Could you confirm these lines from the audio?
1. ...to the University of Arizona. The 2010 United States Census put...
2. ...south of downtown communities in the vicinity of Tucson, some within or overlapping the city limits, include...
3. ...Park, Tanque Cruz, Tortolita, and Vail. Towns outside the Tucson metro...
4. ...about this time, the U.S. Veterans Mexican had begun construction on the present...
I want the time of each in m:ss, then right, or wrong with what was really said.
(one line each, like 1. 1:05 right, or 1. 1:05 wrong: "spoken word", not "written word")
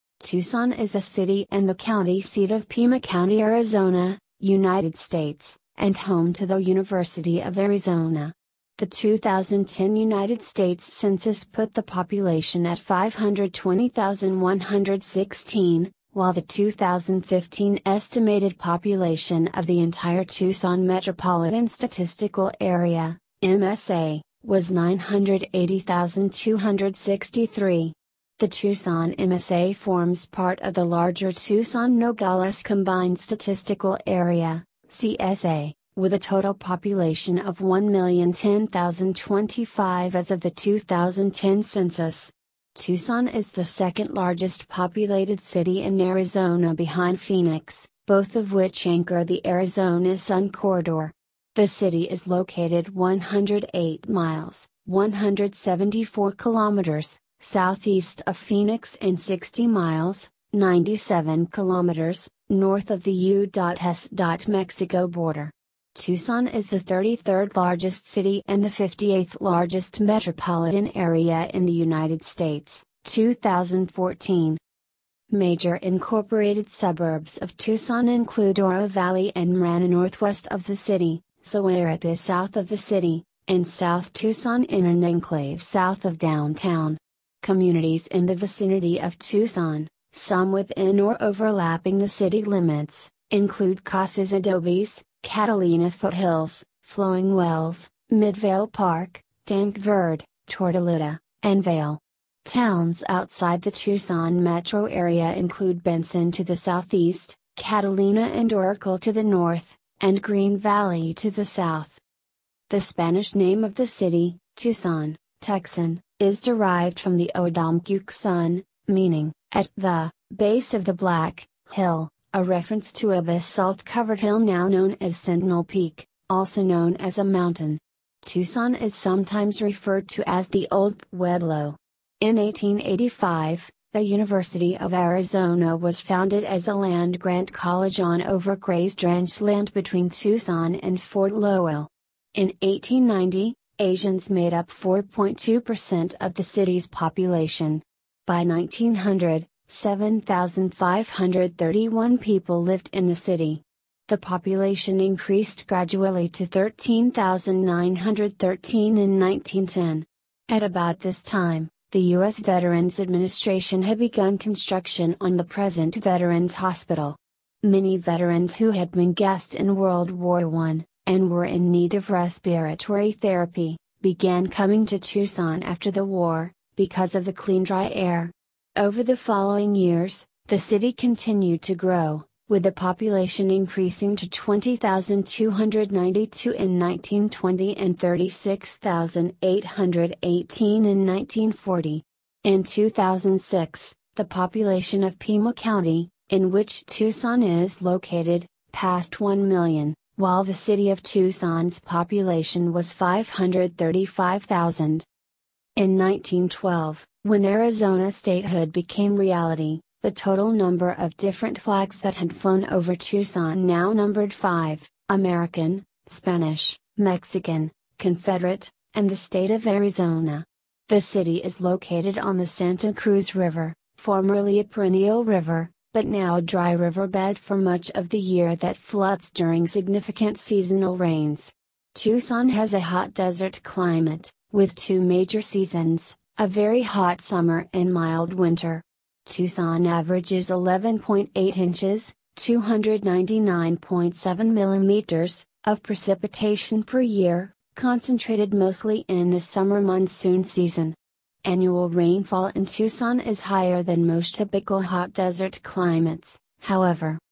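1. 0:06 right
2. 1:25 right
3. 1:38 wrong: "Verde", not "Cruz"
4. 2:40 wrong: "Administration", not "Mexican".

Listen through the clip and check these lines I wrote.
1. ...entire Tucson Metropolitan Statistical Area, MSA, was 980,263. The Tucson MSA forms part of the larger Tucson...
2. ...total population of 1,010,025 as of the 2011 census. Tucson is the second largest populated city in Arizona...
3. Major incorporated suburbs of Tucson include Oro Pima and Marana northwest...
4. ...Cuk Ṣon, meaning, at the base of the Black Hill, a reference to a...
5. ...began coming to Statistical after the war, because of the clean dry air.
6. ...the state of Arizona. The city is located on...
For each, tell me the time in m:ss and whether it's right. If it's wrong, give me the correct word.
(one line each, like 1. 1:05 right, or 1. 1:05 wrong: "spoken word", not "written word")
1. 0:19 right
2. 0:36 wrong: "2010", not "2011"
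3. 1:15 wrong: "Valley", not "Pima"
4. 1:57 right
5. 2:54 wrong: "Tucson", not "Statistical"
6. 3:39 right.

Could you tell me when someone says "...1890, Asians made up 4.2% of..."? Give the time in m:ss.
2:22.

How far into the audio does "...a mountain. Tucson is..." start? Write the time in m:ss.
2:07.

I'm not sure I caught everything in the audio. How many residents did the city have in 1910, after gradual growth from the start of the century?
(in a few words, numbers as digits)
13,913.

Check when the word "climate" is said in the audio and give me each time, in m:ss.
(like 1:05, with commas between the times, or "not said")
3:53, 4:15.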